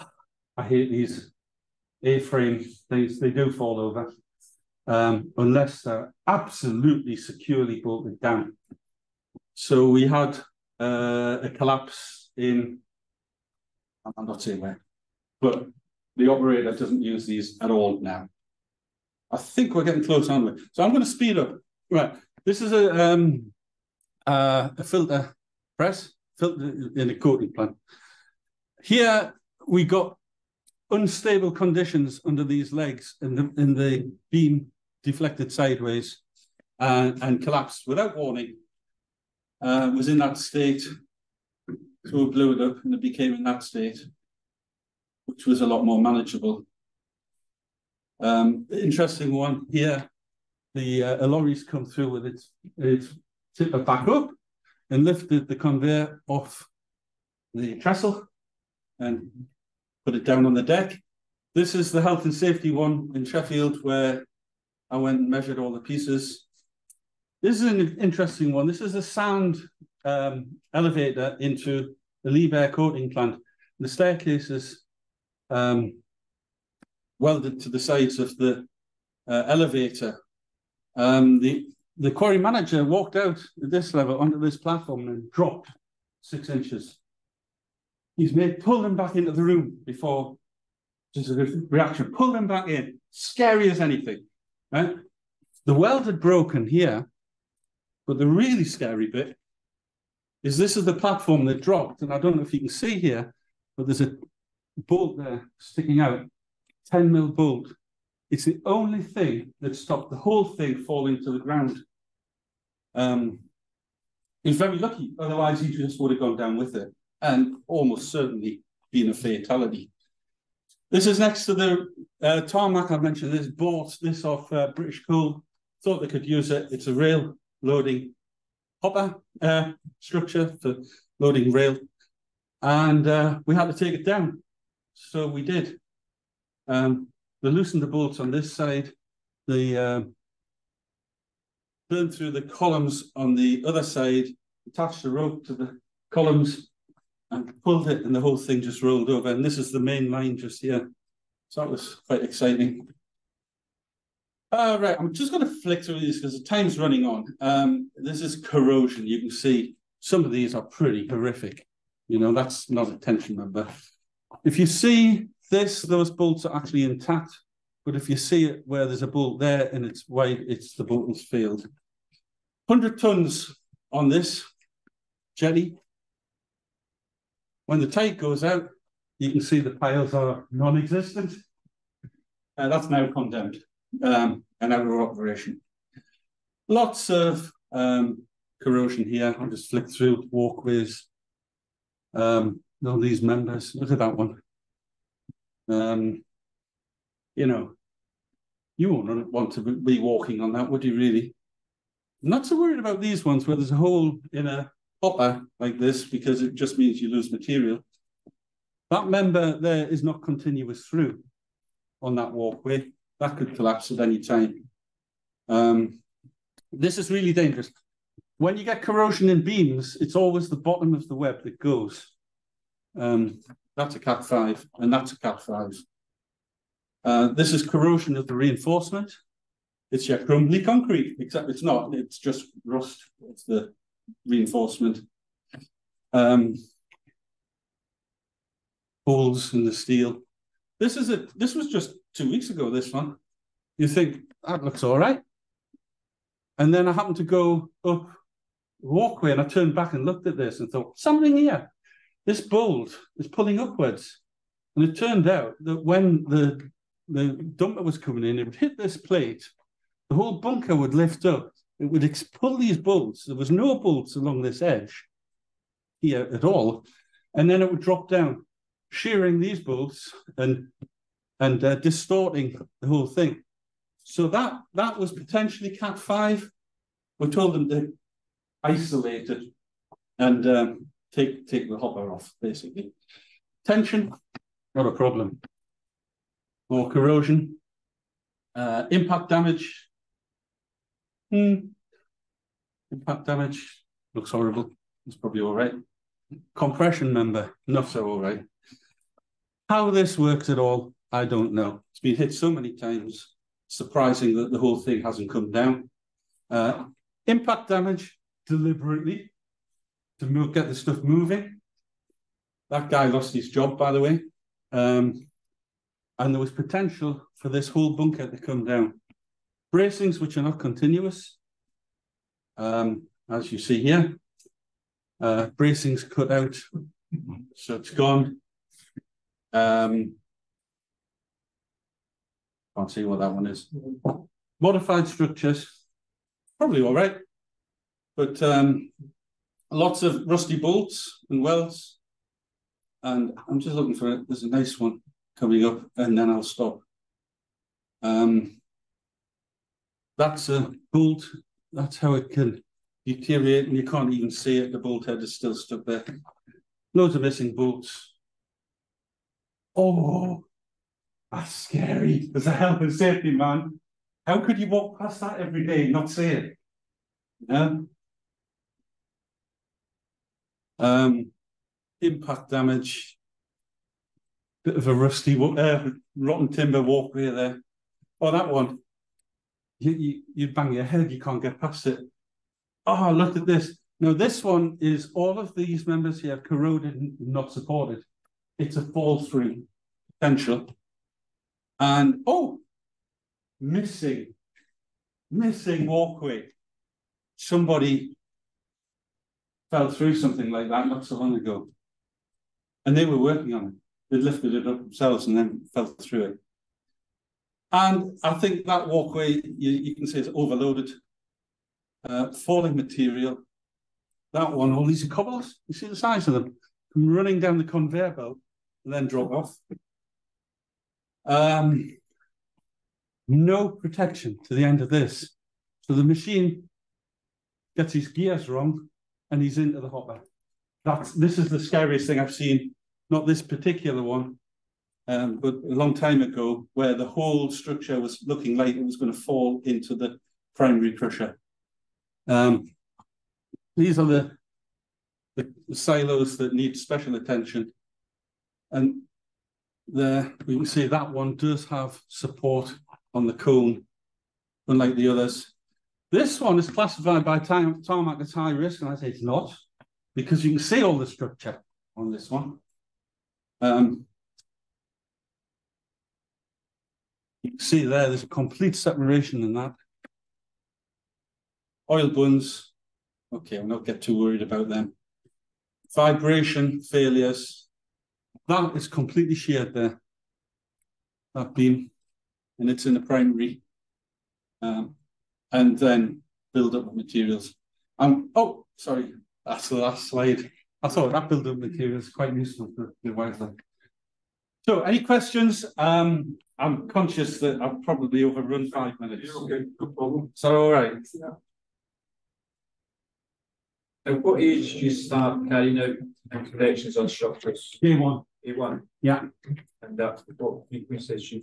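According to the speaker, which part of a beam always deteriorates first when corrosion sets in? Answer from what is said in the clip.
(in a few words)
bottom of the web.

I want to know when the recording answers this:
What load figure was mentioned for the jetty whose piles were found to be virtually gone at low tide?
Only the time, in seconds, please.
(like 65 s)
172 s.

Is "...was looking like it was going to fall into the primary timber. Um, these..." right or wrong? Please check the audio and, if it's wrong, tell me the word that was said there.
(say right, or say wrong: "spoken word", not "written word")
wrong: "crusher", not "timber".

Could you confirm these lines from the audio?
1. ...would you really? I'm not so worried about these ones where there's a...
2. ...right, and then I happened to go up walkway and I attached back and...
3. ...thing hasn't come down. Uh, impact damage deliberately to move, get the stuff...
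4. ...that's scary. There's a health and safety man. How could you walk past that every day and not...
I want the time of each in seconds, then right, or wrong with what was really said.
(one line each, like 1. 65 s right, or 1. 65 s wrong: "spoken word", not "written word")
1. 200 s right
2. 244 s wrong: "turned", not "attached"
3. 304 s right
4. 361 s right.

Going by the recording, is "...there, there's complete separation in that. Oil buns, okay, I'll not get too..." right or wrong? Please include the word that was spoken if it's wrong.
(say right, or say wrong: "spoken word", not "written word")
right.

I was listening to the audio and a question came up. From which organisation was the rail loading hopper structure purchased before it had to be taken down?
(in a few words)
British Coal.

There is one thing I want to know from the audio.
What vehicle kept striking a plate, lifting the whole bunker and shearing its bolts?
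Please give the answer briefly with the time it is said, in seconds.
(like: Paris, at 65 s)
dumper, at 257 s.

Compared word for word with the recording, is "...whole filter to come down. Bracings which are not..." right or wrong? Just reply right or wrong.
wrong.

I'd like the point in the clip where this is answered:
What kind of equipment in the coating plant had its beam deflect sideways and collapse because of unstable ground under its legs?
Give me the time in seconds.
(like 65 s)
24 s.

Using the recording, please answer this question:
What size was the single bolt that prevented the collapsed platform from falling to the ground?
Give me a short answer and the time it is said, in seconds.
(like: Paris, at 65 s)
10 mm, at 106 s.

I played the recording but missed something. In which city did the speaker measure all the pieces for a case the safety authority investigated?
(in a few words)
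Sheffield.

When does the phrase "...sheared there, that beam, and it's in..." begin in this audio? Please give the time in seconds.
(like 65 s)
479 s.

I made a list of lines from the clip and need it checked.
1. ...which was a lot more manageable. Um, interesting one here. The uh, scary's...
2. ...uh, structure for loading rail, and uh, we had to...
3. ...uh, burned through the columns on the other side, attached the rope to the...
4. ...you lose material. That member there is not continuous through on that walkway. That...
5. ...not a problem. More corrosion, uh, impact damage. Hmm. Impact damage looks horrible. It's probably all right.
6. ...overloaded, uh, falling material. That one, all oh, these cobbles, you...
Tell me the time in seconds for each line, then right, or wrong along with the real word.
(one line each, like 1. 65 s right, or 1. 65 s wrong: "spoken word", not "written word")
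1. 45 s wrong: "lorry", not "scary"
2. 129 s right
3. 139 s right
4. 207 s right
5. 284 s right
6. 410 s right.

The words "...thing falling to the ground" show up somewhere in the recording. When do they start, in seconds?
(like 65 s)
110 s.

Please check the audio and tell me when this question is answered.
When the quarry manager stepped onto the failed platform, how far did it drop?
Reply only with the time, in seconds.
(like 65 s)
86 s.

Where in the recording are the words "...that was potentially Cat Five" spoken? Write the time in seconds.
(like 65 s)
274 s.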